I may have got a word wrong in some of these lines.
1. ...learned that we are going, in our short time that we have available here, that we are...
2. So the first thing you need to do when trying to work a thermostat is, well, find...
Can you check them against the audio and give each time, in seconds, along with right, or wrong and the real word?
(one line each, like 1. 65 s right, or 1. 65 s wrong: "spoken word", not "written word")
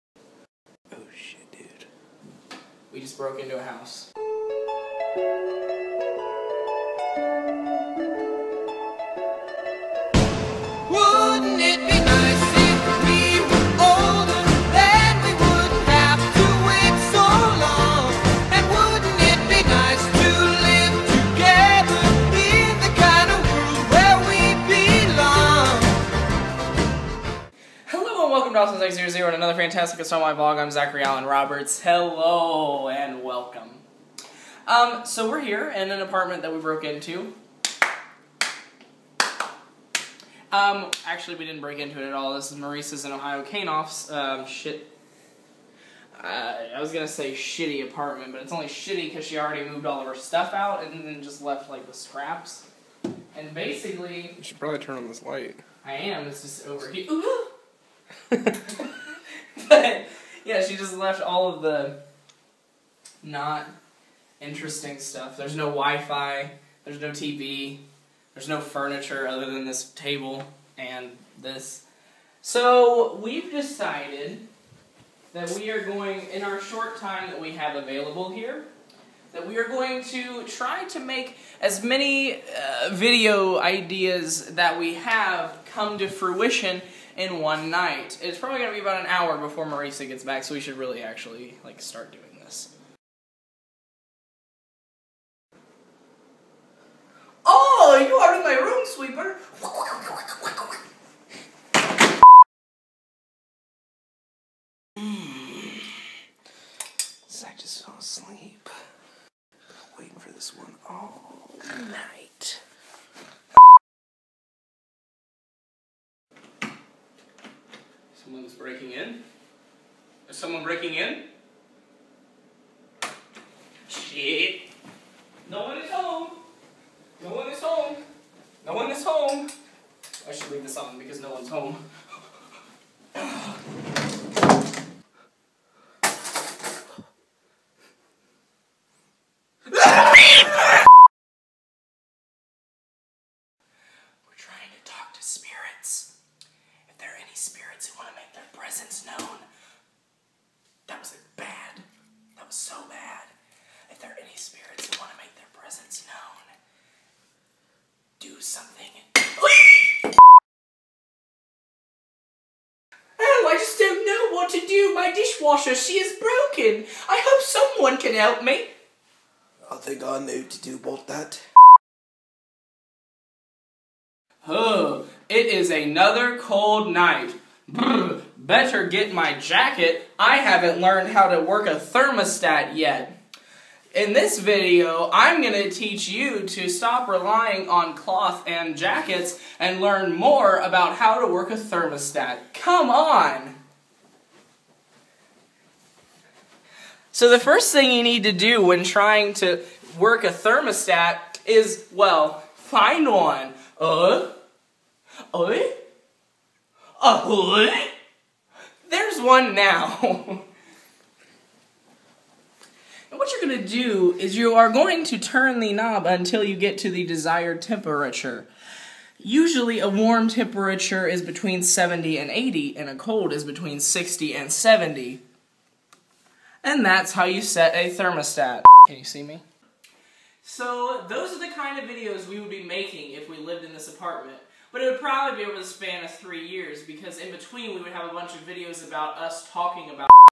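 1. 73 s wrong: "decided", not "learned"
2. 197 s right.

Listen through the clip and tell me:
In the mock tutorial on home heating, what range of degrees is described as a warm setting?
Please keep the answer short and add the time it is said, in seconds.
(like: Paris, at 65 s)
70 to 80, at 221 s.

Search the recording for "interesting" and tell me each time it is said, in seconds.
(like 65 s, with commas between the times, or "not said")
64 s.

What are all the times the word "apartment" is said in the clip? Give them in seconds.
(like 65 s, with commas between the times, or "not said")
35 s, 47 s, 233 s.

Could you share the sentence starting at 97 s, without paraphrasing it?
Oh, you are in my room, sweeper.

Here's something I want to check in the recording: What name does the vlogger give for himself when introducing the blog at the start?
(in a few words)
Zachary Allen Roberts.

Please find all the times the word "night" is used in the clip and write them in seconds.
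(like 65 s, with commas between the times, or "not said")
87 s, 111 s, 176 s.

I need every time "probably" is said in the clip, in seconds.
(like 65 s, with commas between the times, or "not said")
54 s, 88 s, 235 s.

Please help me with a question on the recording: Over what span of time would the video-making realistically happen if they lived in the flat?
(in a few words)
3 years.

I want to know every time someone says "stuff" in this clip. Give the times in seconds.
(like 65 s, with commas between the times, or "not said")
50 s, 64 s.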